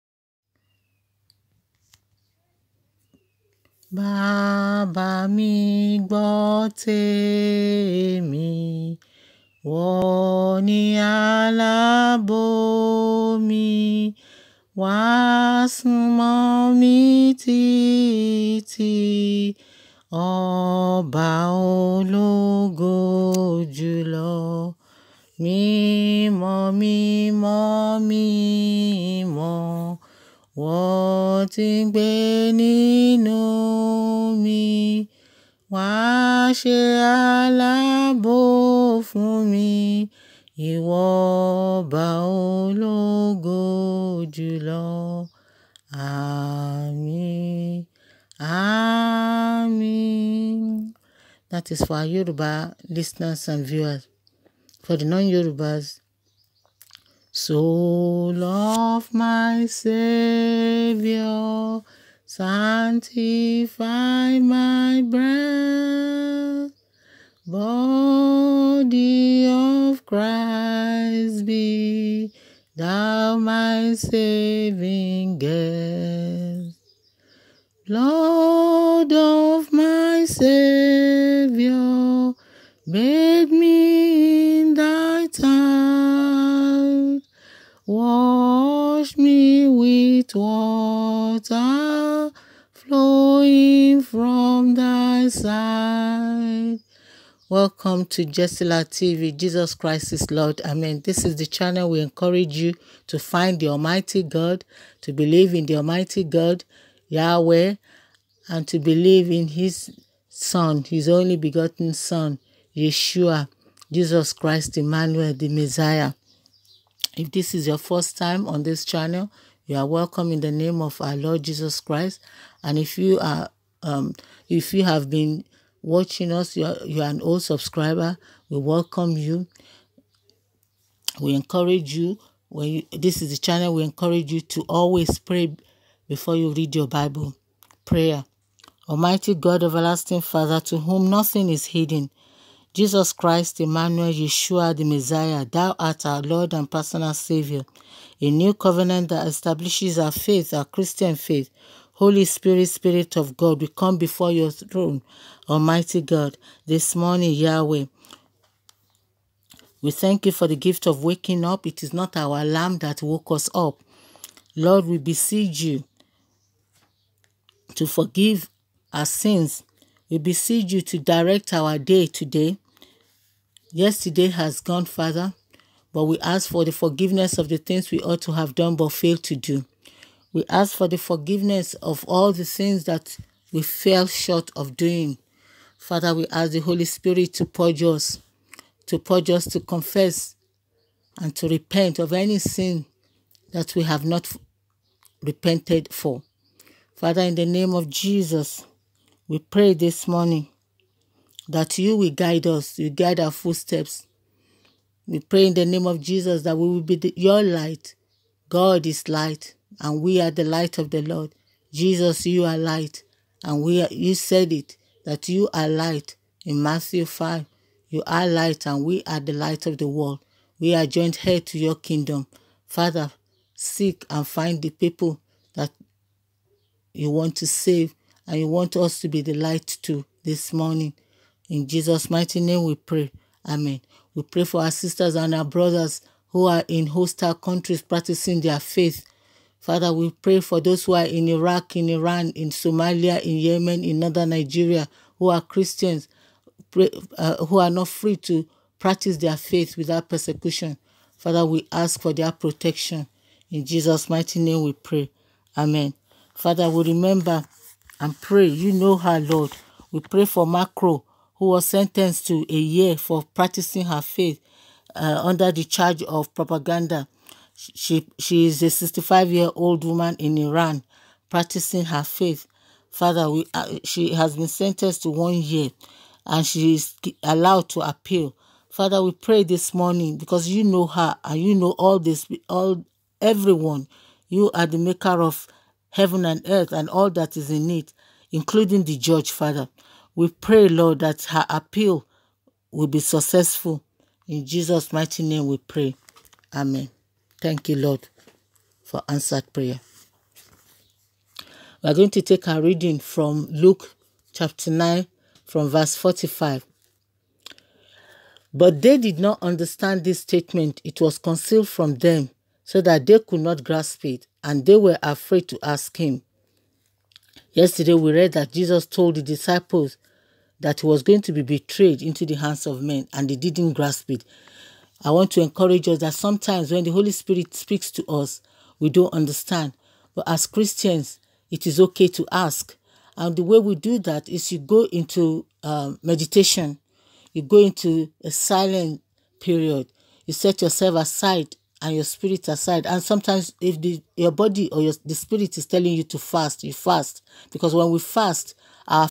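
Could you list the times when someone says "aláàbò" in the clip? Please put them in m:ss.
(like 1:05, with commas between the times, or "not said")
0:11, 0:37.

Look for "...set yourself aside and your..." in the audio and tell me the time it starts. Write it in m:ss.
5:40.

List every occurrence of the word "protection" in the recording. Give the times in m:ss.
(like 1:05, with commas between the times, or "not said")
4:12.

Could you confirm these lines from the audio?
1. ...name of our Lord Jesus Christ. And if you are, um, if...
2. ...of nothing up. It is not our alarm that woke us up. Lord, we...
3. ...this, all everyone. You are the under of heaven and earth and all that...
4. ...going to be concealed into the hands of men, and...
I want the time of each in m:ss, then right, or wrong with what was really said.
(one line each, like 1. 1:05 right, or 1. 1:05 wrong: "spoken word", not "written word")
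1. 2:00 right
2. 2:40 wrong: "waking", not "nothing"
3. 4:41 wrong: "maker", not "under"
4. 5:21 wrong: "betrayed", not "concealed".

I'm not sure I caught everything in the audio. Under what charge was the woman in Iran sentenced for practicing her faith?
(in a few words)
propaganda.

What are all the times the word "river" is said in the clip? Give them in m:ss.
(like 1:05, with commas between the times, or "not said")
not said.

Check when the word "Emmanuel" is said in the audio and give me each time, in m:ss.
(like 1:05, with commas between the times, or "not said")
1:54, 2:23.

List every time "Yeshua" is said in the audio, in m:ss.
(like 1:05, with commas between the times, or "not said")
1:52, 2:24.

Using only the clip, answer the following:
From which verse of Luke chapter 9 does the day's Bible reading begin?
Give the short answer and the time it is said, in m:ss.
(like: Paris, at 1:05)
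45, at 5:05.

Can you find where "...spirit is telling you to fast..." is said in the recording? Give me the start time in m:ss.
5:45.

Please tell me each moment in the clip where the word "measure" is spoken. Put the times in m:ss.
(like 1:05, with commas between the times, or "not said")
not said.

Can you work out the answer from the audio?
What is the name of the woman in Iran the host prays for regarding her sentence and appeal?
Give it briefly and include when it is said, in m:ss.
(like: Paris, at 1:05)
Mahrokh, at 4:20.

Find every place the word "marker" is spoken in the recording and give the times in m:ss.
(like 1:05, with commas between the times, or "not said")
not said.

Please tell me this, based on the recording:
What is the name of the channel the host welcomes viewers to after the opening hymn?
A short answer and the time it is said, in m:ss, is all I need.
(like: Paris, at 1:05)
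Jessila TV, at 1:38.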